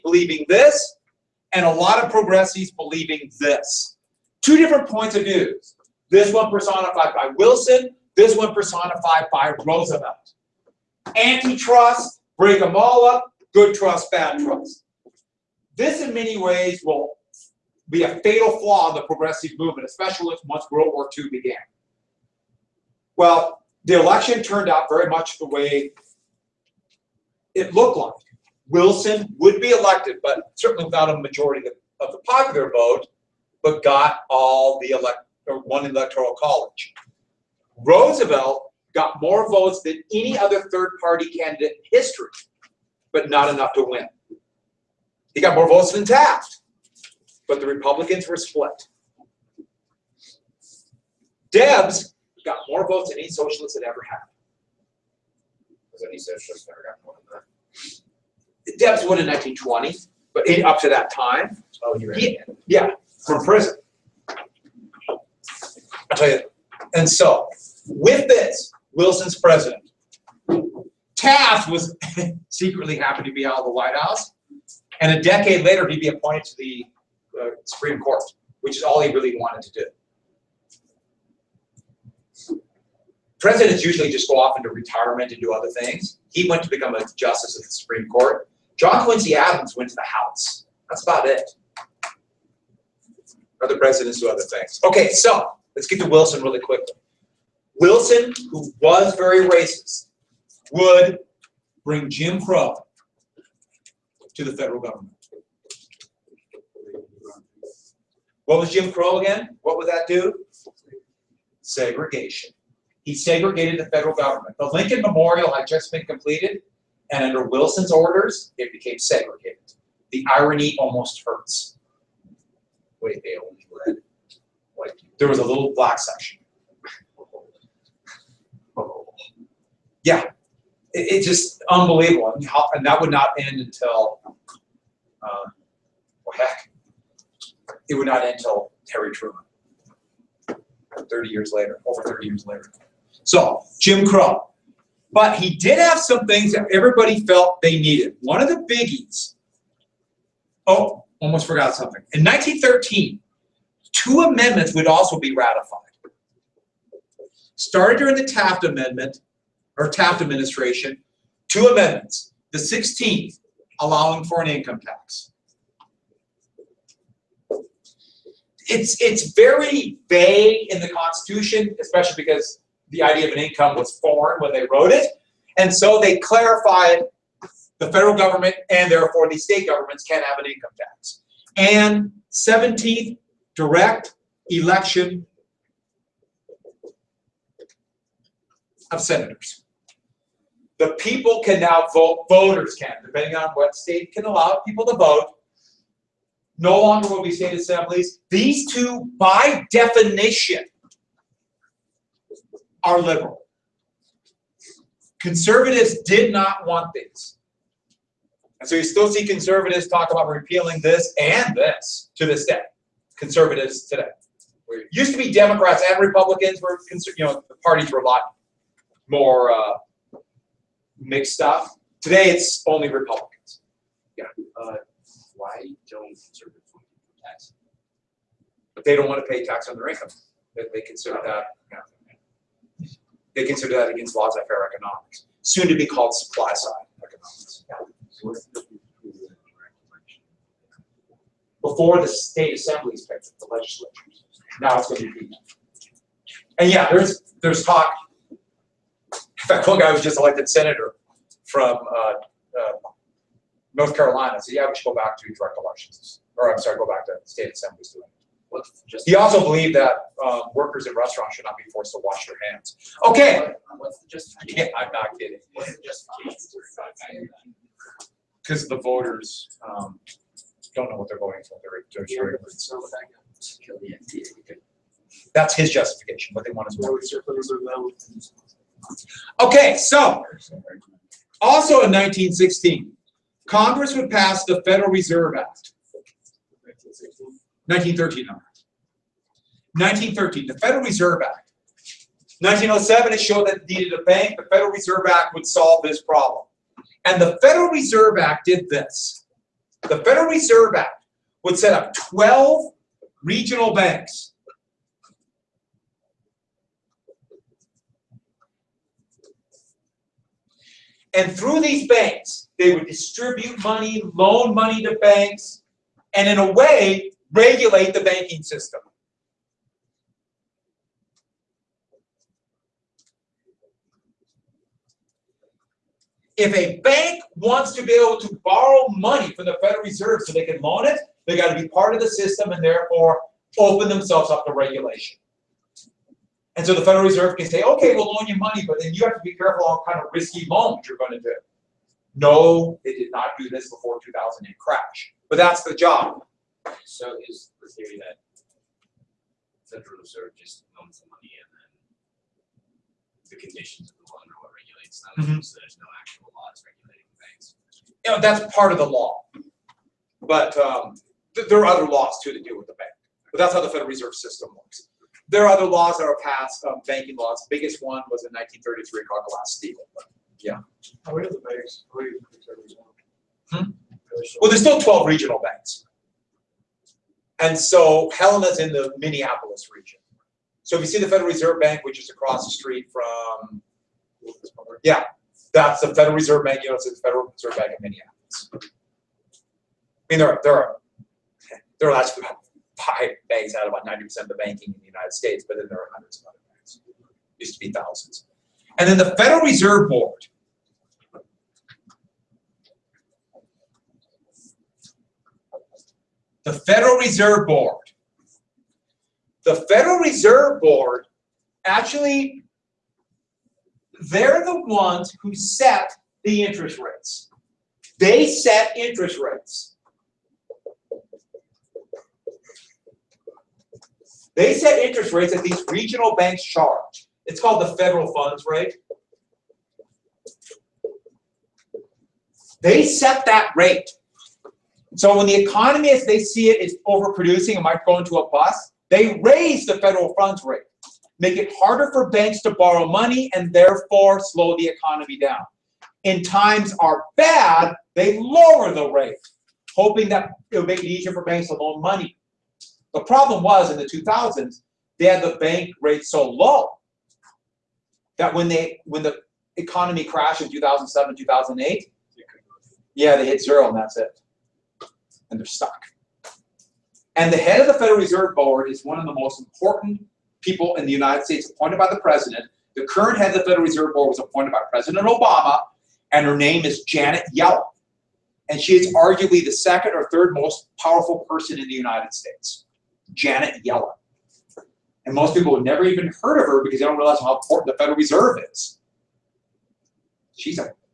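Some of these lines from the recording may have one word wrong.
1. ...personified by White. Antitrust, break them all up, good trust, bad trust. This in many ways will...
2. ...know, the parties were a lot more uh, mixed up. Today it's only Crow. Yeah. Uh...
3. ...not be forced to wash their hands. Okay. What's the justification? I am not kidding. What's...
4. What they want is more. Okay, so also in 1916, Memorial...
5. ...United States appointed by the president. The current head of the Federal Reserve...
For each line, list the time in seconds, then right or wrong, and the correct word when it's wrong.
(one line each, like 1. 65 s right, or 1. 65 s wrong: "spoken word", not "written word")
1. 8 s wrong: "Roosevelt", not "White"
2. 217 s wrong: "Republicans", not "Crow"
3. 261 s right
4. 276 s wrong: "Congress", not "Memorial"
5. 470 s right.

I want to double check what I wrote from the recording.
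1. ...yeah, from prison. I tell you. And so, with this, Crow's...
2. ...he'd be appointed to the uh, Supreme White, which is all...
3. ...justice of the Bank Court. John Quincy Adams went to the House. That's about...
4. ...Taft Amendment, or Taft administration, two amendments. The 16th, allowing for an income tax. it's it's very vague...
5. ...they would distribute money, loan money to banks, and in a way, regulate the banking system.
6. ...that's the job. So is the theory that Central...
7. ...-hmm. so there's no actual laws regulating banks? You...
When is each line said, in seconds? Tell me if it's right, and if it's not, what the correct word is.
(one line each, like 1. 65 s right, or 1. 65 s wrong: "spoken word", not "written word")
1. 62 s wrong: "Wilson", not "Crow"
2. 75 s wrong: "Court", not "White"
3. 87 s wrong: "Supreme", not "Bank"
4. 158 s right
5. 312 s right
6. 345 s right
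7. 355 s right.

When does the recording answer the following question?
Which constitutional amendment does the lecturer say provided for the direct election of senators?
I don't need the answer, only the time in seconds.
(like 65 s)
182 s.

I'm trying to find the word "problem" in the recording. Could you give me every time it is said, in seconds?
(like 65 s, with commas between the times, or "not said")
296 s, 453 s.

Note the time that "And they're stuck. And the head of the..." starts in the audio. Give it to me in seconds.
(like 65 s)
465 s.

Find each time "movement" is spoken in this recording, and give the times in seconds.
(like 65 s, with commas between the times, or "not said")
19 s.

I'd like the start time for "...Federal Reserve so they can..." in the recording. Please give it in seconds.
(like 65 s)
329 s.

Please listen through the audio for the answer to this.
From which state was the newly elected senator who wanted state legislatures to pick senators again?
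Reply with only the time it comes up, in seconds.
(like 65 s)
253 s.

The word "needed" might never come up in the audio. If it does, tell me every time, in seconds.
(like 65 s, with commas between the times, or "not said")
147 s, 293 s.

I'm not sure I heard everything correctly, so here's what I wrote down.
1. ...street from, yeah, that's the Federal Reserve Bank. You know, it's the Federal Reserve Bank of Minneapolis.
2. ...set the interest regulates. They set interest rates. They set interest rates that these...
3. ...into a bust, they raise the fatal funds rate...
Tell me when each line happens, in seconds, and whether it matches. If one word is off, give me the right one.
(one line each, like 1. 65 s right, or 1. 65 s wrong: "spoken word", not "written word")
1. 382 s right
2. 415 s wrong: "rates", not "regulates"
3. 437 s wrong: "federal", not "fatal".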